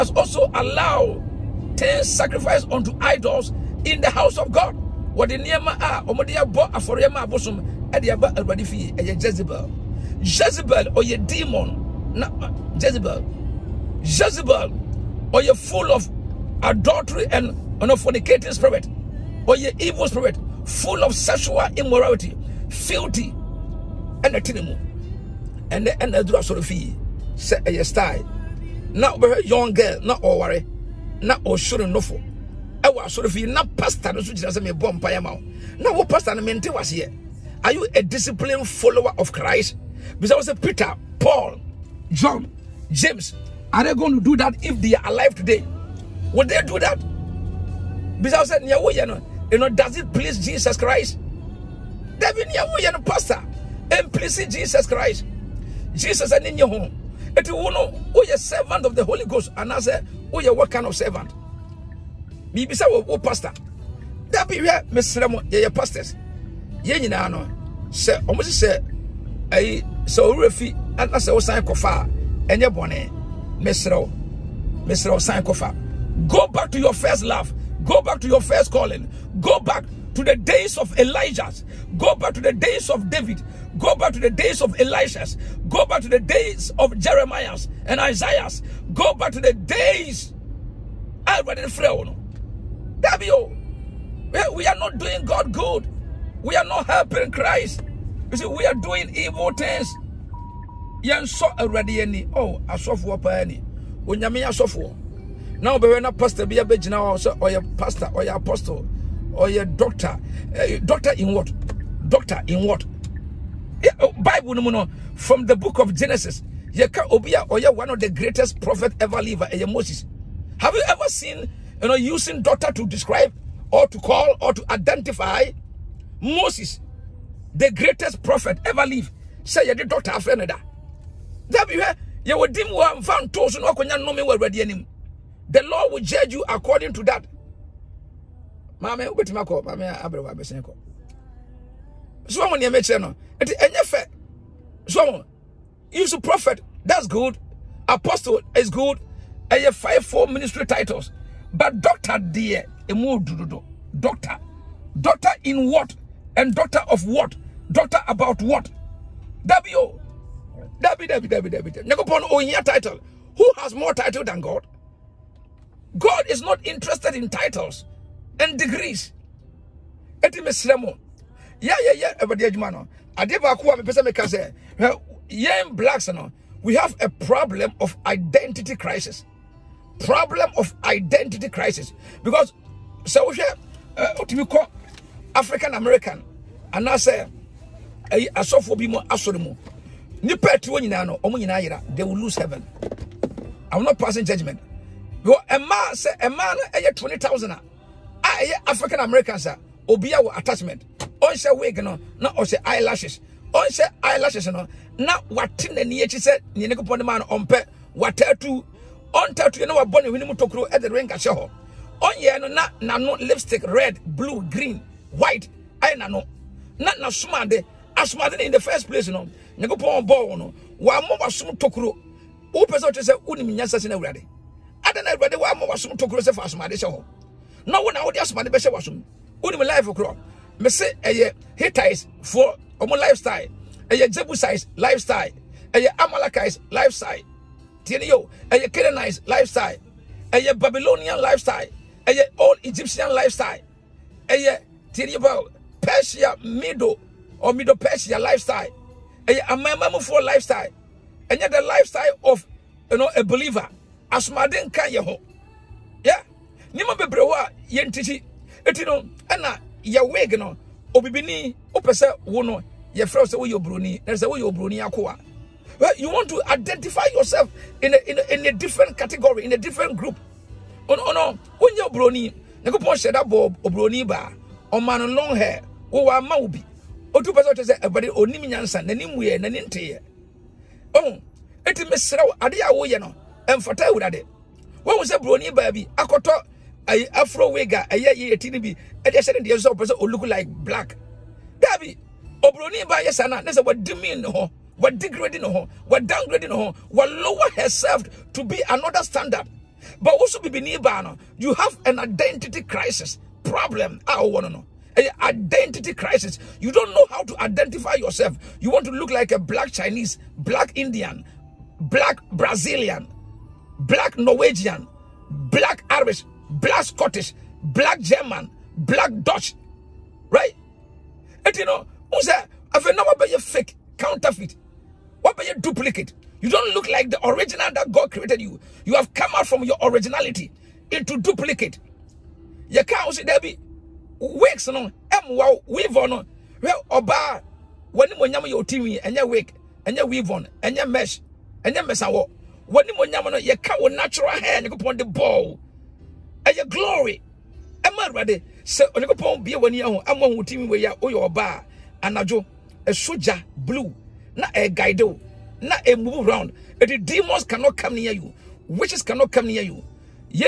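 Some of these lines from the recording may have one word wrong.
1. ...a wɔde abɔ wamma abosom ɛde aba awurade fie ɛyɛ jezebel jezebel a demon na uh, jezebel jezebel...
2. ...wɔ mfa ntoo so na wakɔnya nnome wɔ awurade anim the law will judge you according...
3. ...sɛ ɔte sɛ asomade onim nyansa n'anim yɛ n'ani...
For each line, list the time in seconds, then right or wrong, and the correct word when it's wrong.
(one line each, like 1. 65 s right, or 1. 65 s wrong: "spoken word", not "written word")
1. 5 s wrong: "afɔrɛma", not "wamma"
2. 132 s right
3. 277 s wrong: "ɛbɛde", not "asomade".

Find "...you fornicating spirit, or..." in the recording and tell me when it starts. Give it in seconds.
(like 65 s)
17 s.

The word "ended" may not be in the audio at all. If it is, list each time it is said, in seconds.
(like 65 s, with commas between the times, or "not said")
not said.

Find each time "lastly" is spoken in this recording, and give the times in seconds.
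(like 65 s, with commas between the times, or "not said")
not said.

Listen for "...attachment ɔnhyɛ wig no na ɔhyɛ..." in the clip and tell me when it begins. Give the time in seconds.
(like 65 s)
200 s.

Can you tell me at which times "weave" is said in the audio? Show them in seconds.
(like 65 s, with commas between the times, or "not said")
335 s, 340 s.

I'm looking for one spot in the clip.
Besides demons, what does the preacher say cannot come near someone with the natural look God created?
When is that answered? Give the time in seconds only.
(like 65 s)
358 s.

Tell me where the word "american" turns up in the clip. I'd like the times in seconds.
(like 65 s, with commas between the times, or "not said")
185 s, 199 s.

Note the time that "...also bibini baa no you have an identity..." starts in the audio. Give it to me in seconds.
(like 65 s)
300 s.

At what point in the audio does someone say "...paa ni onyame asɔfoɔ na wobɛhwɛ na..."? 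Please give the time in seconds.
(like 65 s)
103 s.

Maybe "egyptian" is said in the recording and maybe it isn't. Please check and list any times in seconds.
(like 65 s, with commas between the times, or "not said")
242 s.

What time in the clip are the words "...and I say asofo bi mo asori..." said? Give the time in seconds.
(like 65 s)
186 s.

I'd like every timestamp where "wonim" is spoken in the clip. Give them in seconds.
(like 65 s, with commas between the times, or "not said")
223 s, 229 s.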